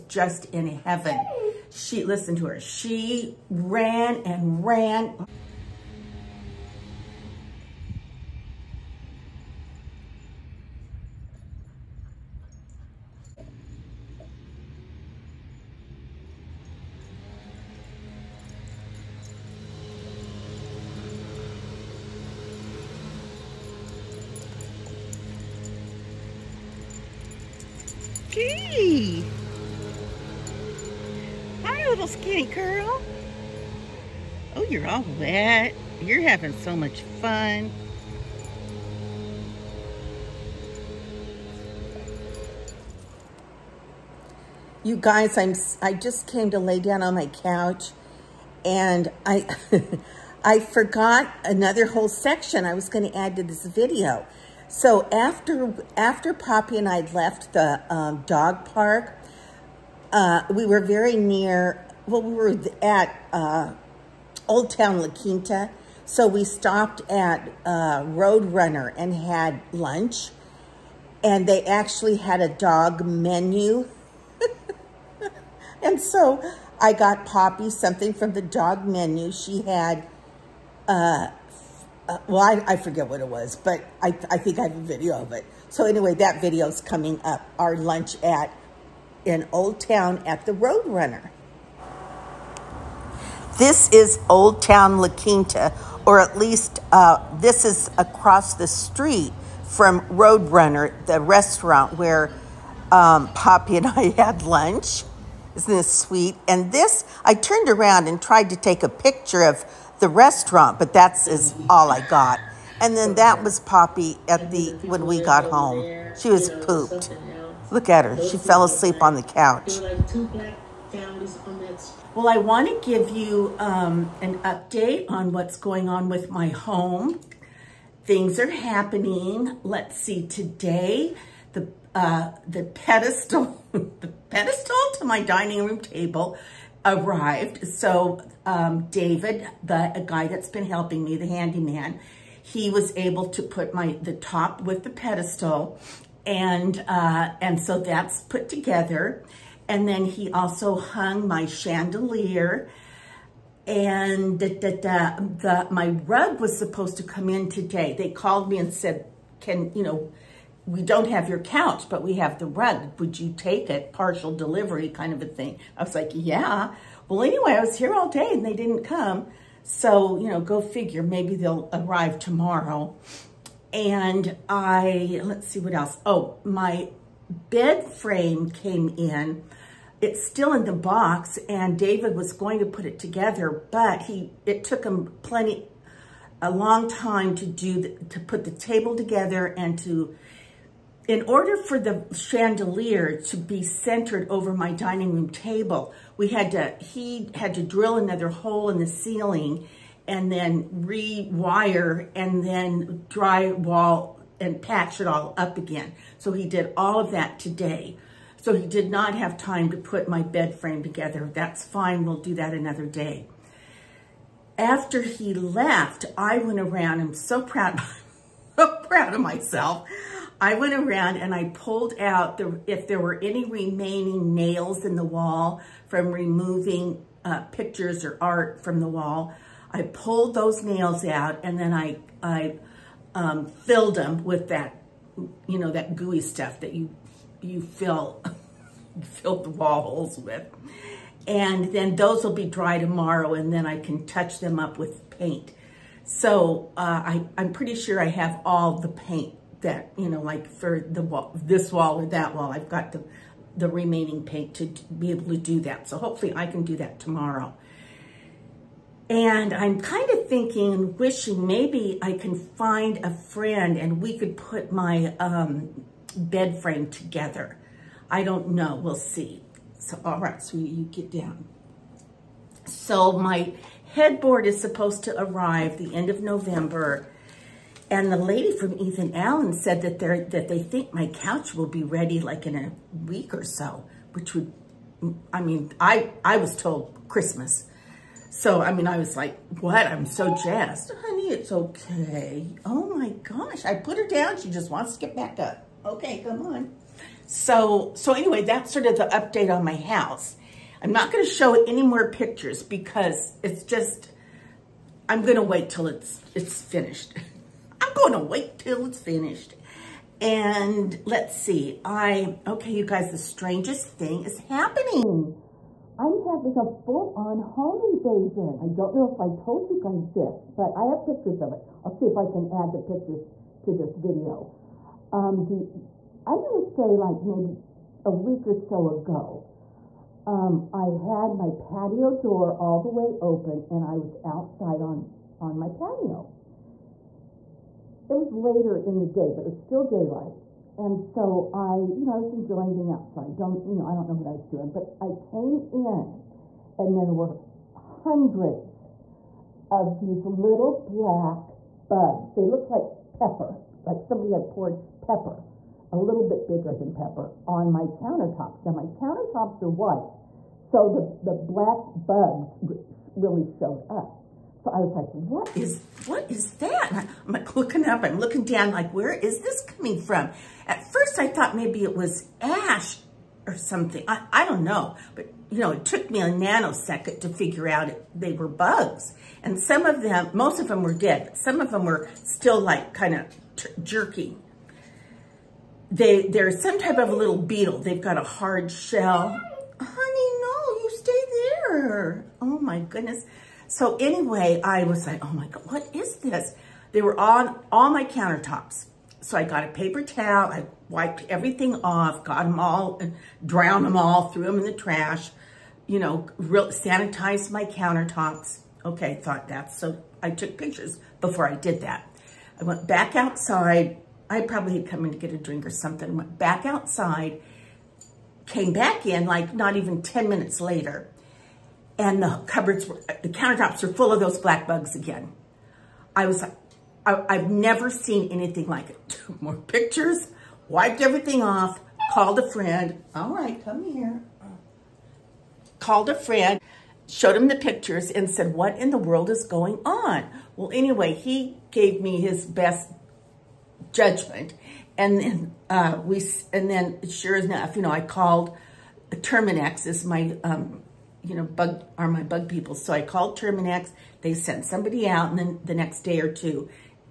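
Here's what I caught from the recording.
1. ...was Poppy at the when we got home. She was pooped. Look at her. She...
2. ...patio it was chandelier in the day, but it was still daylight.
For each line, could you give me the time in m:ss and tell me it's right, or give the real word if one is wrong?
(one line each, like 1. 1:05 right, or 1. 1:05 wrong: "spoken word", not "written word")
1. 1:53 right
2. 5:35 wrong: "later", not "chandelier".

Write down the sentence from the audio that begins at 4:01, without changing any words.
And then those will be dry tomorrow and then I can touch them up with paint.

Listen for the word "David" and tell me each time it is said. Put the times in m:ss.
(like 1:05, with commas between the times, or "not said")
2:18, 3:01.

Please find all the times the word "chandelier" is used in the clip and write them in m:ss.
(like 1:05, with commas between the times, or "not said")
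2:31, 3:12.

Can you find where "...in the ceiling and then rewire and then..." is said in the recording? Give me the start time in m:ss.
3:18.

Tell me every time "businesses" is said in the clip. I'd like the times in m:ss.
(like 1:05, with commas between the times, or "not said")
not said.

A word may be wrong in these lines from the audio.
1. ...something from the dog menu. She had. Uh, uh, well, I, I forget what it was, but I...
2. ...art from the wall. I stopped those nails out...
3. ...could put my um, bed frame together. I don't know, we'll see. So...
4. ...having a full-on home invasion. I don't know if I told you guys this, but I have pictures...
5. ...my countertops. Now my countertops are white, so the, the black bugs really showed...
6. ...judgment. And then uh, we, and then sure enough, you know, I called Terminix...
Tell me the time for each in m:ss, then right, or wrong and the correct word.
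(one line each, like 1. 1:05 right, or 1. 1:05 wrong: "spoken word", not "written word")
1. 1:17 right
2. 3:48 wrong: "pulled", not "stopped"
3. 4:24 right
4. 5:16 right
5. 5:57 right
6. 7:23 right.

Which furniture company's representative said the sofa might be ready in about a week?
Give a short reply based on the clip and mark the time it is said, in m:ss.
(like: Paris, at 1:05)
Ethan Allen, at 4:38.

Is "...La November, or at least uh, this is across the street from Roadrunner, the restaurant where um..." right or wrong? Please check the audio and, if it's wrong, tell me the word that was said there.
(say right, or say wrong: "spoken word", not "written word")
wrong: "Quinta", not "November".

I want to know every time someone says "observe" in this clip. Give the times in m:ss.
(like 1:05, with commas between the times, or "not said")
not said.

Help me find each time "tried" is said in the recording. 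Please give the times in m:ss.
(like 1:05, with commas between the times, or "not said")
1:48.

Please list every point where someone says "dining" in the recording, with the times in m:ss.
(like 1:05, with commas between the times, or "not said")
2:15, 3:14.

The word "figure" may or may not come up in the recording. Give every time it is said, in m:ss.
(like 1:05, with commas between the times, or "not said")
2:50, 6:17.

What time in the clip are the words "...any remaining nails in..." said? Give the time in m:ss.
3:43.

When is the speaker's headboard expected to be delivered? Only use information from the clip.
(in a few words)
end of November.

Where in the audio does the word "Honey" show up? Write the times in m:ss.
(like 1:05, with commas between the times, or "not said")
4:50, 6:29.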